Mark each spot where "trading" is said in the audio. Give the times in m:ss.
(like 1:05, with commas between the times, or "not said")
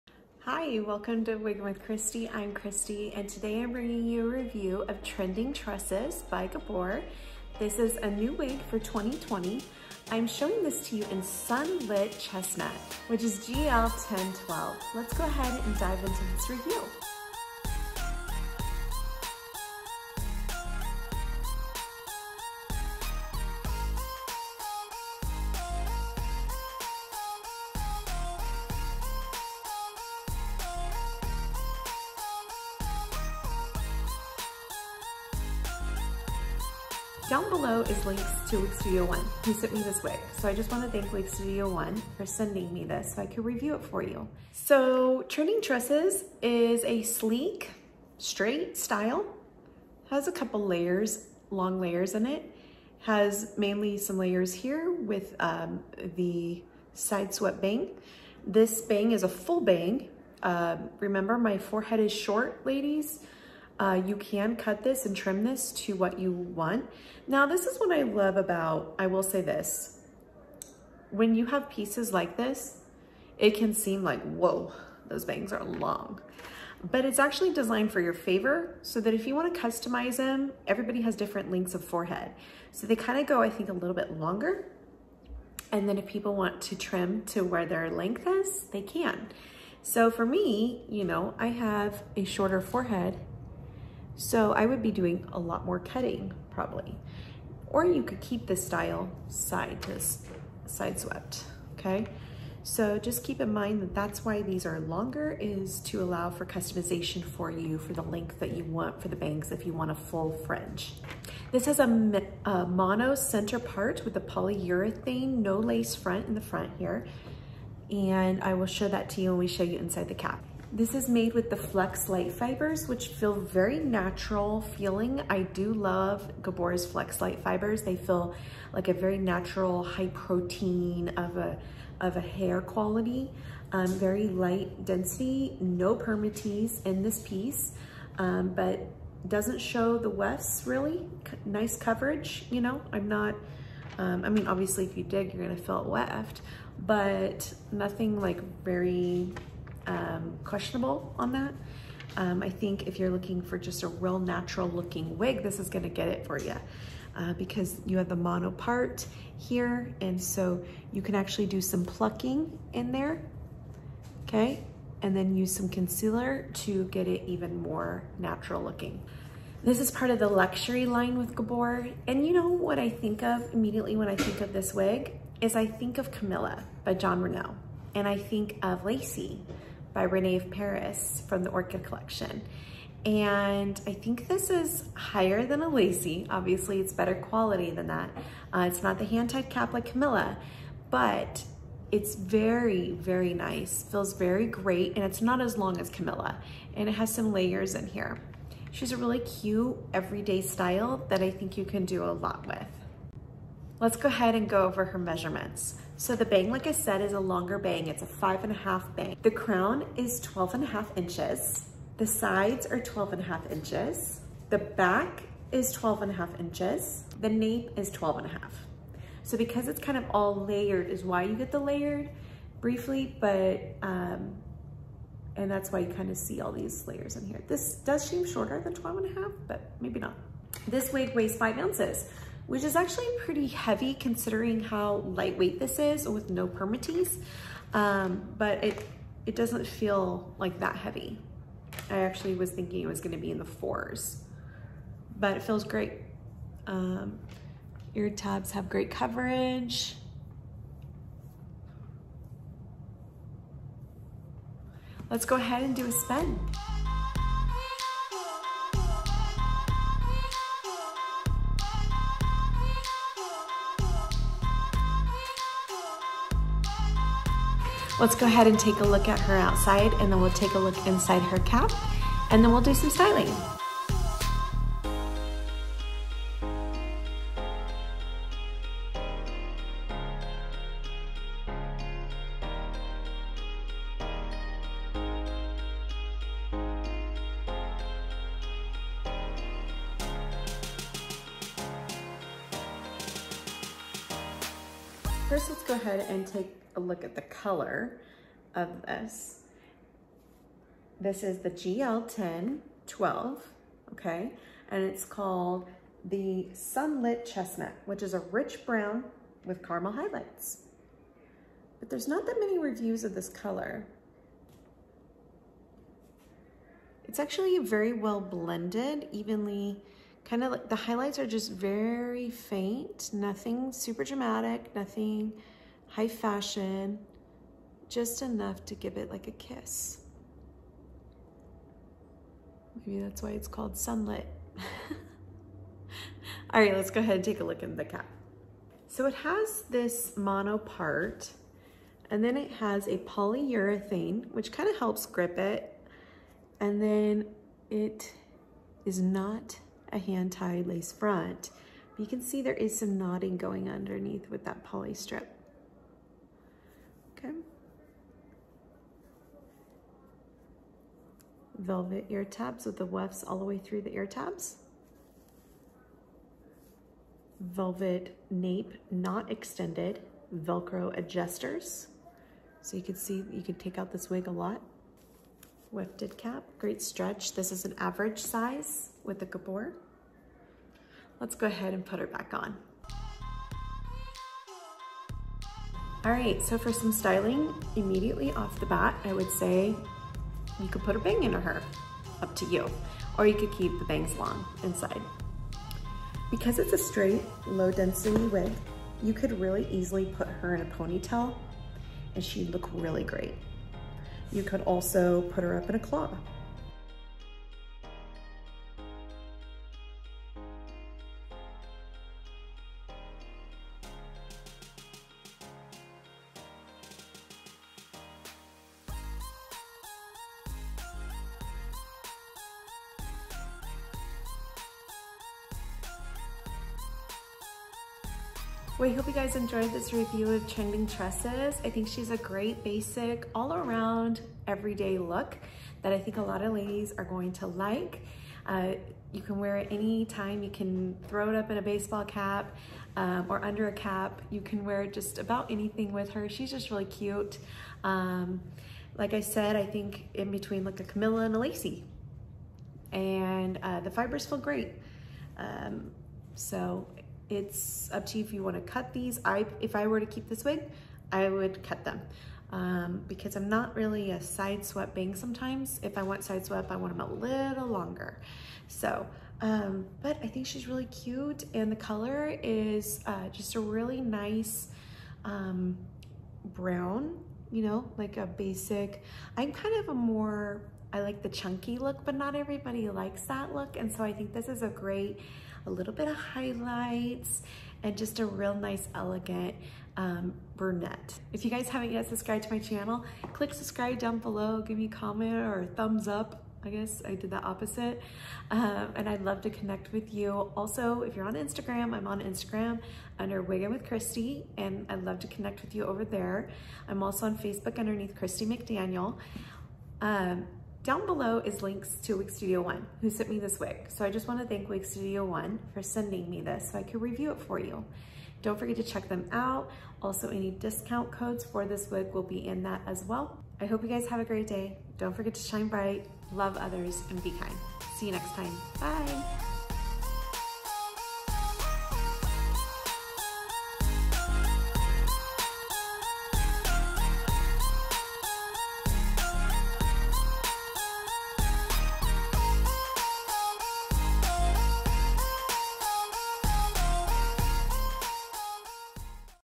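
not said.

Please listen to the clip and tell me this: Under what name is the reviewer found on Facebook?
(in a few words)
Christi McDaniel.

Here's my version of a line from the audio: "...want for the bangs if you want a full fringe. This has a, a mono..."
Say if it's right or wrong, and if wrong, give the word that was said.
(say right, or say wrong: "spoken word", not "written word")
right.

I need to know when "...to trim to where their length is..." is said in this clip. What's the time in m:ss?
1:26.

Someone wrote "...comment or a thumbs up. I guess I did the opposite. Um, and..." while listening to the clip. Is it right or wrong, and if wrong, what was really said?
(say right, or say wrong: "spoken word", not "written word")
right.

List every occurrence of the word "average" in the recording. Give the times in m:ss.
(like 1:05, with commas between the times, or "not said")
6:17.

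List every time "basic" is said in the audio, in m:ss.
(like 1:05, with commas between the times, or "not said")
7:12, 7:58.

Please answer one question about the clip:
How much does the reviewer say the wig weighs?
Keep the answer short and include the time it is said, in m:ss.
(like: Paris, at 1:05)
5 ounces, at 3:51.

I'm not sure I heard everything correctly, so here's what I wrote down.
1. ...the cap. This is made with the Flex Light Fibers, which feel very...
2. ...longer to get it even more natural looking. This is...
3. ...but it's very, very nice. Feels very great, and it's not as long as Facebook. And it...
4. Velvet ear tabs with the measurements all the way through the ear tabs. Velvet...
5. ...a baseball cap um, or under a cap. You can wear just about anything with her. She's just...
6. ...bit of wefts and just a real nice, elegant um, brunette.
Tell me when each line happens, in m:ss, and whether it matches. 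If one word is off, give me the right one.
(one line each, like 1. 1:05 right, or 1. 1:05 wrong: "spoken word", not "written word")
1. 2:00 right
2. 2:45 wrong: "concealer", not "longer"
3. 3:10 wrong: "Camilla", not "Facebook"
4. 6:01 wrong: "wefts", not "measurements"
5. 7:21 right
6. 8:05 wrong: "highlights", not "wefts".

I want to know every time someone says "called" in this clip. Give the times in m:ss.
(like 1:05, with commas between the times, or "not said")
5:05, 5:33.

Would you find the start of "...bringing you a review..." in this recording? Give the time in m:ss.
0:03.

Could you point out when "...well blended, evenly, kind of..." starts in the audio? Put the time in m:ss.
5:17.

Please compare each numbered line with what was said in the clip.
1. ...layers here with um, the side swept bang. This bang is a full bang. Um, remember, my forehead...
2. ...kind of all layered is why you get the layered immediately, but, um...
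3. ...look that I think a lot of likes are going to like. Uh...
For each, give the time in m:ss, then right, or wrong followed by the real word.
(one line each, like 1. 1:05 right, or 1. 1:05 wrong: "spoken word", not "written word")
1. 0:54 right
2. 3:39 wrong: "briefly", not "immediately"
3. 7:14 wrong: "ladies", not "likes".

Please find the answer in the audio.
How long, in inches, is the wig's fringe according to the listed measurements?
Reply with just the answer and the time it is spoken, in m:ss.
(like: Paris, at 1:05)
5.5 inches, at 3:28.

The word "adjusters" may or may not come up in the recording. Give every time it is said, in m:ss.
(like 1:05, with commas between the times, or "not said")
6:10.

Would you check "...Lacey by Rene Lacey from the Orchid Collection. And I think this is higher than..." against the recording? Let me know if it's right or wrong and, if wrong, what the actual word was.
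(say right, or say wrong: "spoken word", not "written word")
wrong: "Paris", not "Lacey".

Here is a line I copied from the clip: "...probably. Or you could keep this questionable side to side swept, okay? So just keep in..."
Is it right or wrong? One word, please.
wrong.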